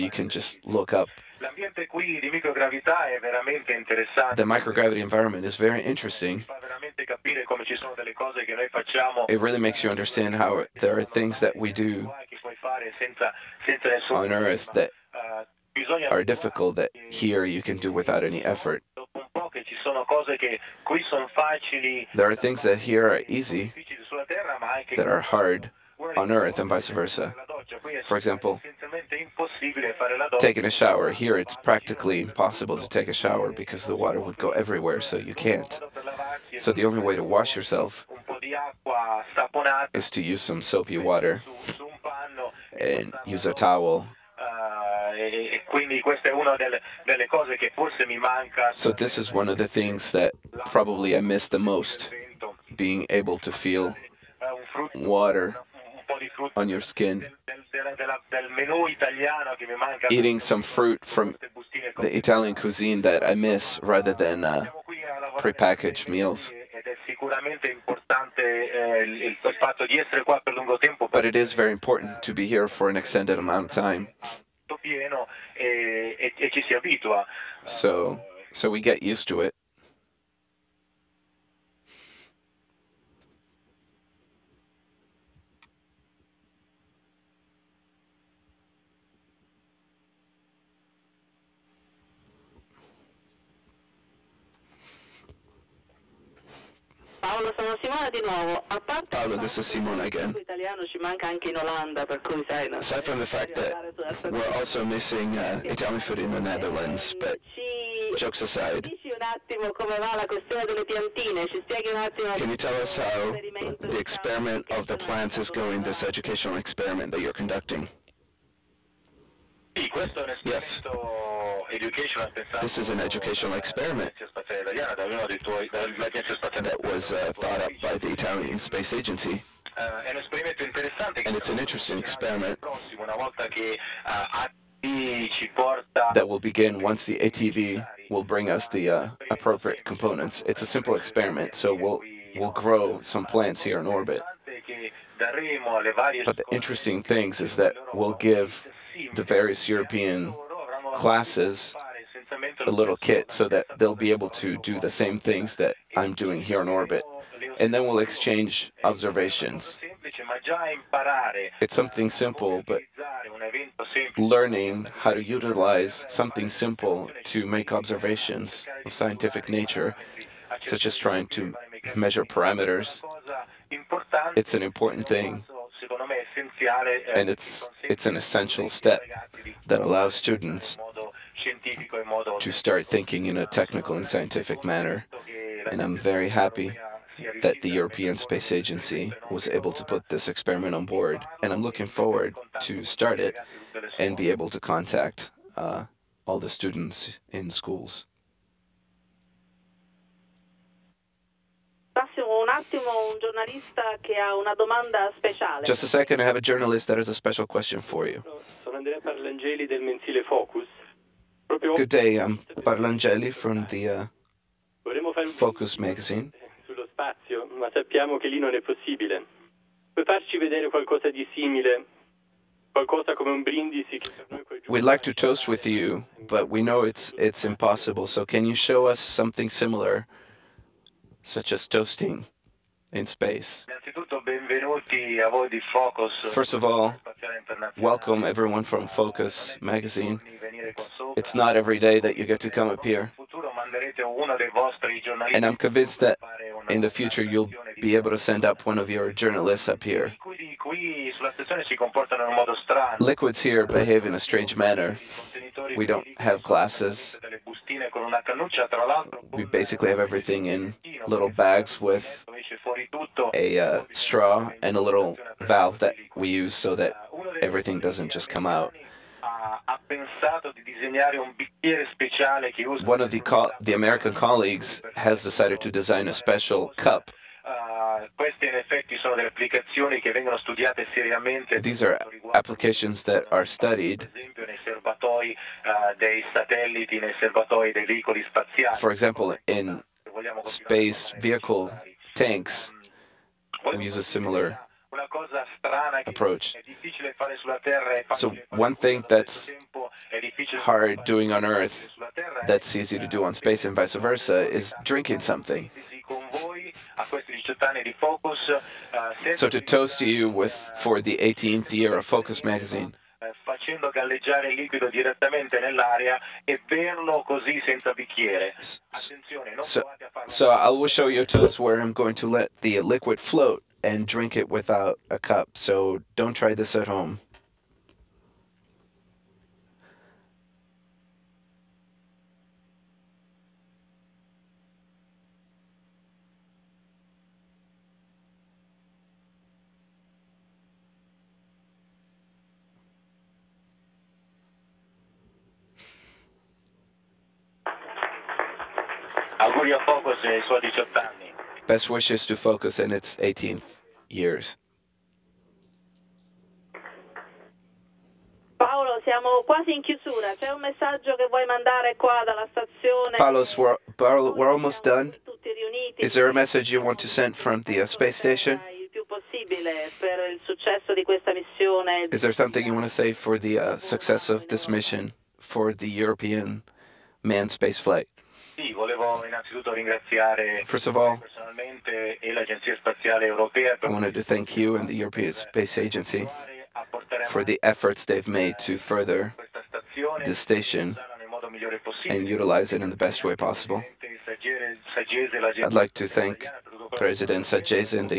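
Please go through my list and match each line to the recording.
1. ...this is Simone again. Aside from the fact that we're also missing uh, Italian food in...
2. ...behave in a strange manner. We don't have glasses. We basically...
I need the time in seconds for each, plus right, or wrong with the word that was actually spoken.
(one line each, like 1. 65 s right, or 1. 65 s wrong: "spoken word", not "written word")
1. 99 s right
2. 253 s right.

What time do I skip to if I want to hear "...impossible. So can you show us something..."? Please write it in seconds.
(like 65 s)
227 s.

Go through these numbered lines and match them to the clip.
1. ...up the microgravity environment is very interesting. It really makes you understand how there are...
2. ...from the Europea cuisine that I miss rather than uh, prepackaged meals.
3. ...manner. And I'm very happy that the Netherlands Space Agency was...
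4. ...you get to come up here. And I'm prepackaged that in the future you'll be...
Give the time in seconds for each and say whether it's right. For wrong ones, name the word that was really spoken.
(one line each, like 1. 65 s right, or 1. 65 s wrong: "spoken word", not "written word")
1. 0 s right
2. 61 s wrong: "Italian", not "Europea"
3. 184 s wrong: "European", not "Netherlands"
4. 242 s wrong: "convinced", not "prepackaged".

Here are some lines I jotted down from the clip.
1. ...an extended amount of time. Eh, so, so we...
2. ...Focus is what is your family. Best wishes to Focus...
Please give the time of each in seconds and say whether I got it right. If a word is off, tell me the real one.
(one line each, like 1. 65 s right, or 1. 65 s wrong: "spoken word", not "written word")
1. 72 s right
2. 349 s right.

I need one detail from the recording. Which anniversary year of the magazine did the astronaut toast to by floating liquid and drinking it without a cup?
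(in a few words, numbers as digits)
18th.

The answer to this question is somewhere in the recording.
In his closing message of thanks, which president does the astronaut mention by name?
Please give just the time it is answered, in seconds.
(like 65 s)
396 s.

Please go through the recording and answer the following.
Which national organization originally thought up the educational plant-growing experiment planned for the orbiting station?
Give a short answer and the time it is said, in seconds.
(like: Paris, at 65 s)
Italian Space Agency, at 128 s.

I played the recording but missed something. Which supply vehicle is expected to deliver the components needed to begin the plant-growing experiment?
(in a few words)
ATV.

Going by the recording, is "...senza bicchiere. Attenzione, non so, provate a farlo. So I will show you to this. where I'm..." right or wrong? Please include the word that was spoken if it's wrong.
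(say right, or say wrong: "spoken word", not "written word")
right.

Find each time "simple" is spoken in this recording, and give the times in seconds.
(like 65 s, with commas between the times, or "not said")
140 s, 162 s, 166 s.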